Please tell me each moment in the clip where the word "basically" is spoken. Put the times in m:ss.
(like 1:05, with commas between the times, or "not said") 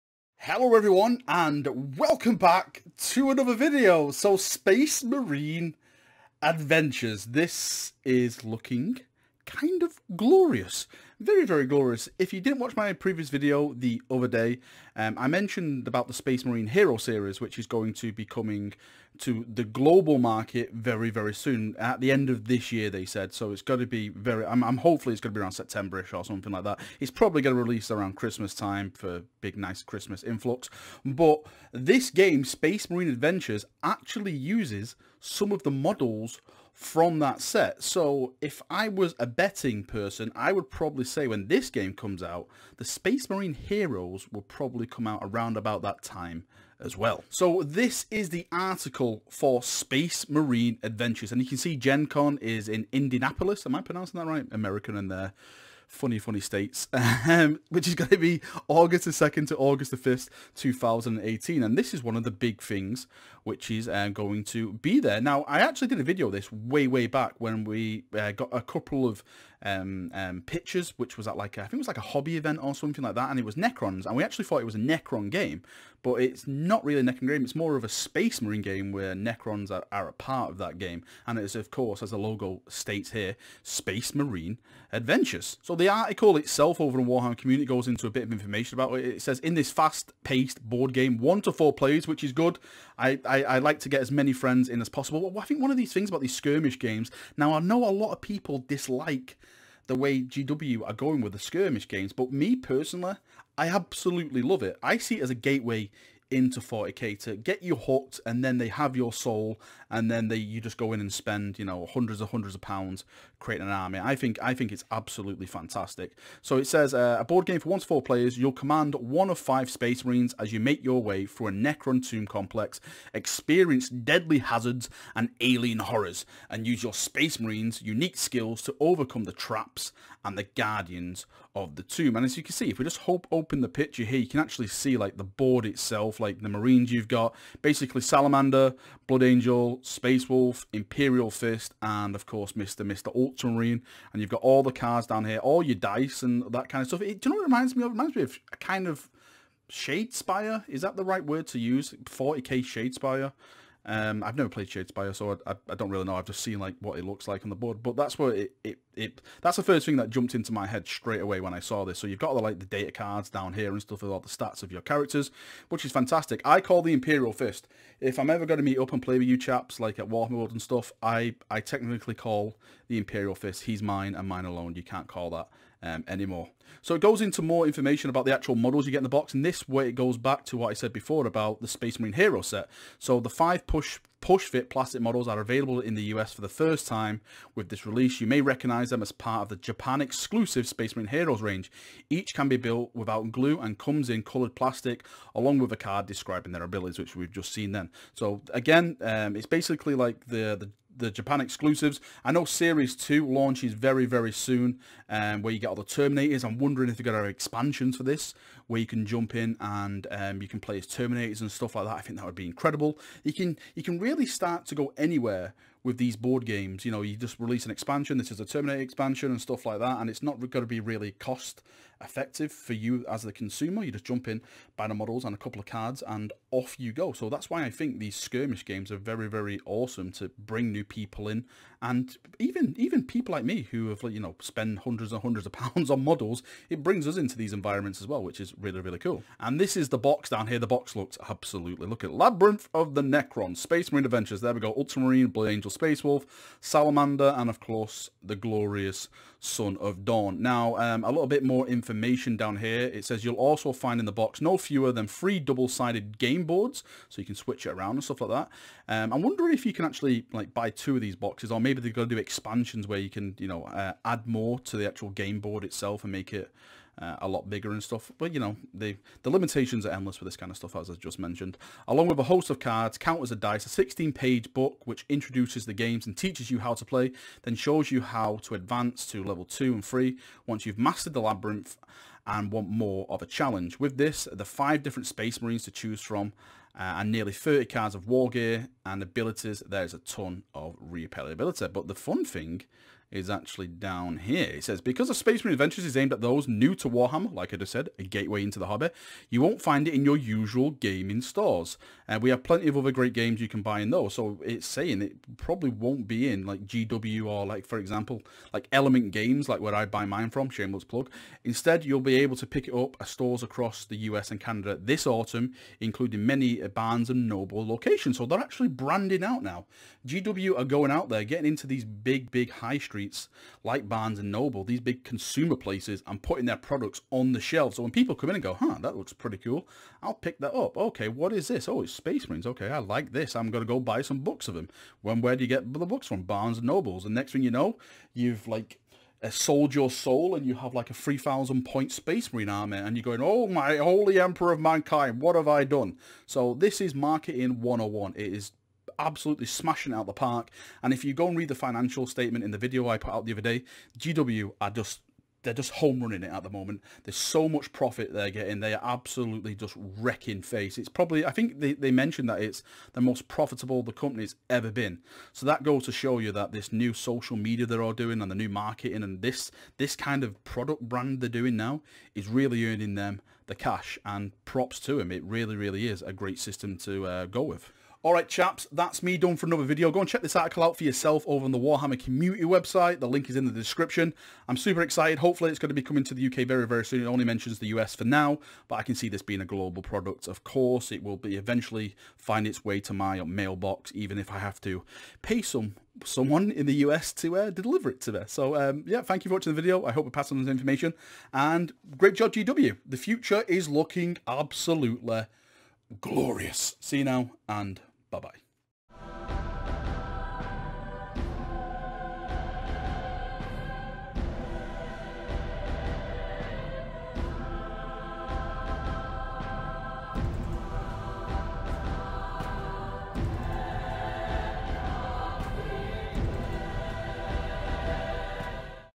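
2:17, 3:19.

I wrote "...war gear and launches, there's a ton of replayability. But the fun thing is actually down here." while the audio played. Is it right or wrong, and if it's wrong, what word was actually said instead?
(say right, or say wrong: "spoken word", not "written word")
wrong: "abilities", not "launches".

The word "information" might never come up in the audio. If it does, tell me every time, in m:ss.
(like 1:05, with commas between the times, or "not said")
1:28, 2:57, 4:11, 6:40.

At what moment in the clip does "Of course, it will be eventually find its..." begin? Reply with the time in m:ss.
6:30.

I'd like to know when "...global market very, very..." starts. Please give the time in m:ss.
0:19.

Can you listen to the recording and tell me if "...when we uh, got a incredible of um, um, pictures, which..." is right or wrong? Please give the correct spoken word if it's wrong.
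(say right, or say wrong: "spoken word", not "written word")
wrong: "couple", not "incredible".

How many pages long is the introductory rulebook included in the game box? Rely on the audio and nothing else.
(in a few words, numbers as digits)
16.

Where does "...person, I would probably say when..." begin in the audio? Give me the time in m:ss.
0:39.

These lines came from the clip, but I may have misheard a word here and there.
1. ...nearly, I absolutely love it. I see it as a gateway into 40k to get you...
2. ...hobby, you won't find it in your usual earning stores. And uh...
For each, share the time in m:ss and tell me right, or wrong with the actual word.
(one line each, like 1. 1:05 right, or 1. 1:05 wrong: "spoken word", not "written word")
1. 1:42 wrong: "personally", not "nearly"
2. 4:58 wrong: "gaming", not "earning".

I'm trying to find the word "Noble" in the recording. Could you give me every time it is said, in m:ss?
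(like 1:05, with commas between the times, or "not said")
5:17, 5:24, 5:36.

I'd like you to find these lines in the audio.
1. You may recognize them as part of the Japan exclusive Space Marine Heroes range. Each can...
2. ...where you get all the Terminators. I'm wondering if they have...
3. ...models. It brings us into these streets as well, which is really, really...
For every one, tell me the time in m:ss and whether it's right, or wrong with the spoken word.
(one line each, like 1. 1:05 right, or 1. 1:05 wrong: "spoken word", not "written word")
1. 3:08 right
2. 3:25 right
3. 3:56 wrong: "environments", not "streets".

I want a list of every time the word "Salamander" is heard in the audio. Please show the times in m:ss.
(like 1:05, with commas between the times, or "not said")
2:17, 4:06.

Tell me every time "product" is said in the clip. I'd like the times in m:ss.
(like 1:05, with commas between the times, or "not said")
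5:26, 6:10, 6:29.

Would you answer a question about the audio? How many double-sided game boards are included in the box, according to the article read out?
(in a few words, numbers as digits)
3.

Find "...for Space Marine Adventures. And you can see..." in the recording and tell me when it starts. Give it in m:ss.
0:49.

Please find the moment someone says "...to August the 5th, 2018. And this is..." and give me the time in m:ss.
0:59.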